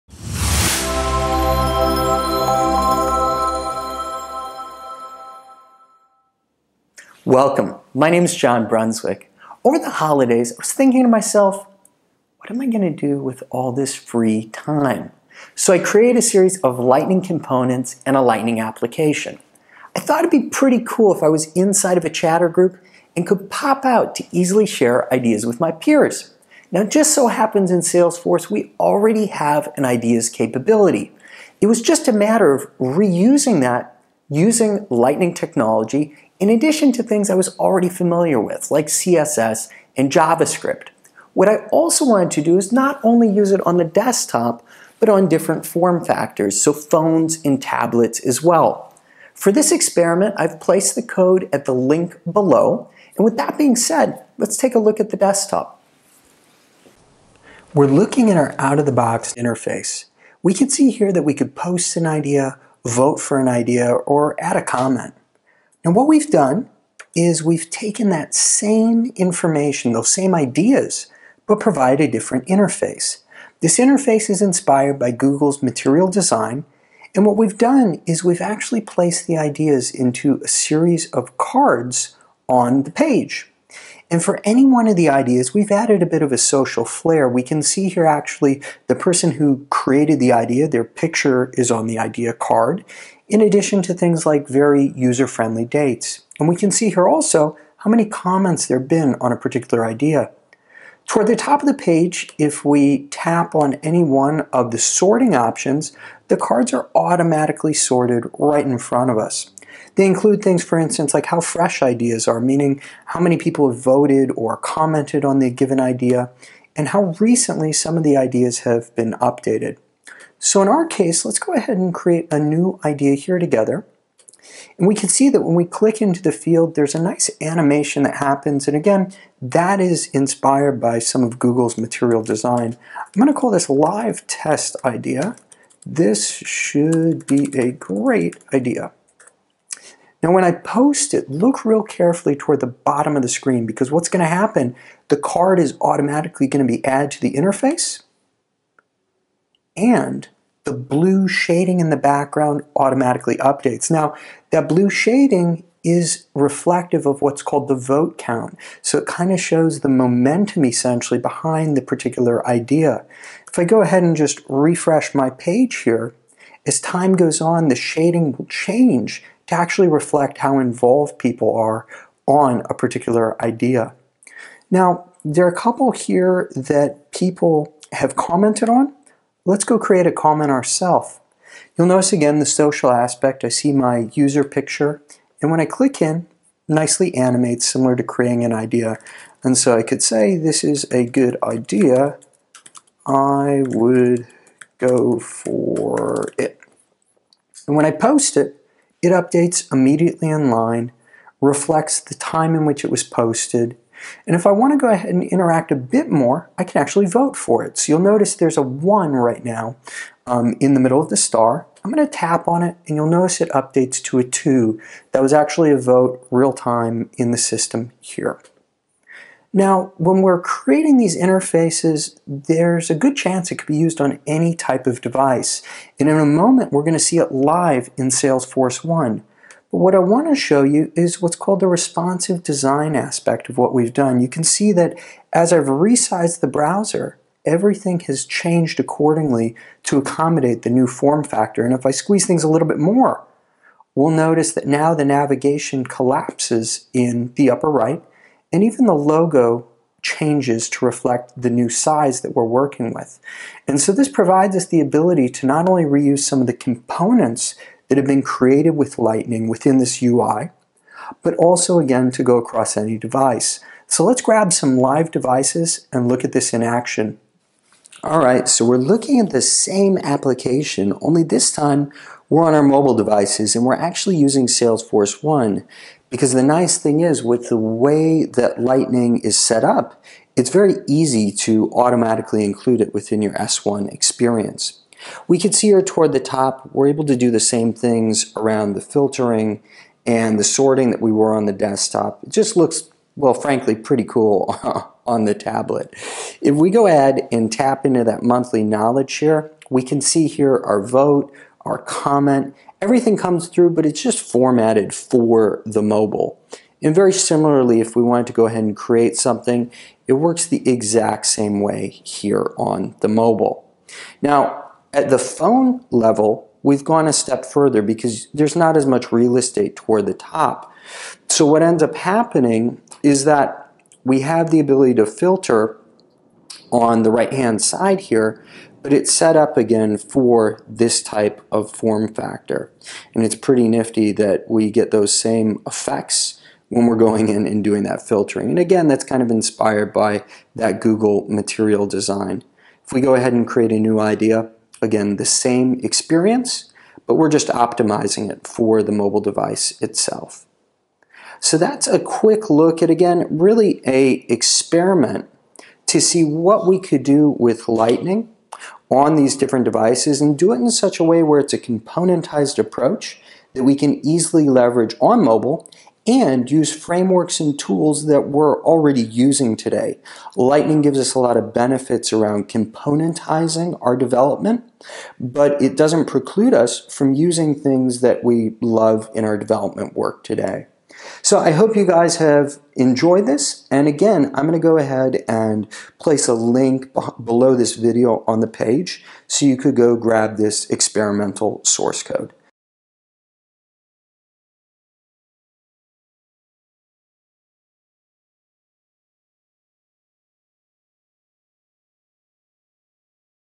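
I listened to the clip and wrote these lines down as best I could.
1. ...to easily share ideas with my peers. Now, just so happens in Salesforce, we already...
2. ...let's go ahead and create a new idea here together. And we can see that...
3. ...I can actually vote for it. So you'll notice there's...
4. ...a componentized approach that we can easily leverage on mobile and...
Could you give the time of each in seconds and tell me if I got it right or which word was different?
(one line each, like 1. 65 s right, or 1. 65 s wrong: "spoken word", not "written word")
1. 24 s right
2. 121 s right
3. 206 s right
4. 361 s right.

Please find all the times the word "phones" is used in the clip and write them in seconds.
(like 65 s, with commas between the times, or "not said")
46 s, 315 s.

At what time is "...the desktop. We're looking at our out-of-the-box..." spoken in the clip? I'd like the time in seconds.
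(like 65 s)
55 s.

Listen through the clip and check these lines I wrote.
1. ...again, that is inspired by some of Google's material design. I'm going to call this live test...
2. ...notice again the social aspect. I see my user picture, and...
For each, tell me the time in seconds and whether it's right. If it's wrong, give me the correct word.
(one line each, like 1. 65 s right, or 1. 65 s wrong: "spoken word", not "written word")
1. 128 s right
2. 181 s right.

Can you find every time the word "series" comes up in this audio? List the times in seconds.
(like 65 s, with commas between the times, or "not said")
16 s, 80 s.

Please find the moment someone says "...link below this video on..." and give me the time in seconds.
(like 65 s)
386 s.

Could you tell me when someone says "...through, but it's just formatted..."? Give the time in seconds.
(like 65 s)
303 s.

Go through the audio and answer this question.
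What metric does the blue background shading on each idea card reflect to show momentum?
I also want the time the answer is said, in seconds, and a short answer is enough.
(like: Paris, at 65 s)
vote count, at 157 s.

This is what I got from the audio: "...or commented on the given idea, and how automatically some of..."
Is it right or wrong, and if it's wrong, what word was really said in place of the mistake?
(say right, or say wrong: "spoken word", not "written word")
wrong: "recently", not "automatically".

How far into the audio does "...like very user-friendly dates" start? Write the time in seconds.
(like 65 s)
94 s.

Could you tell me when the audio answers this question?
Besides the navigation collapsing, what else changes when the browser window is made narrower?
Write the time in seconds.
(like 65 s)
248 s.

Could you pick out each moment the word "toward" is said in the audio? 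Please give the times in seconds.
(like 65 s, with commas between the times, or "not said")
101 s, 142 s, 285 s, 319 s.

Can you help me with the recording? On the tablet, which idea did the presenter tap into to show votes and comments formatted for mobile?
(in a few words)
monthly knowledge.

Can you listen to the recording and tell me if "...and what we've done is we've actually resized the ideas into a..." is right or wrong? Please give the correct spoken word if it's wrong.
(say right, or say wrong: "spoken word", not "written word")
wrong: "placed", not "resized".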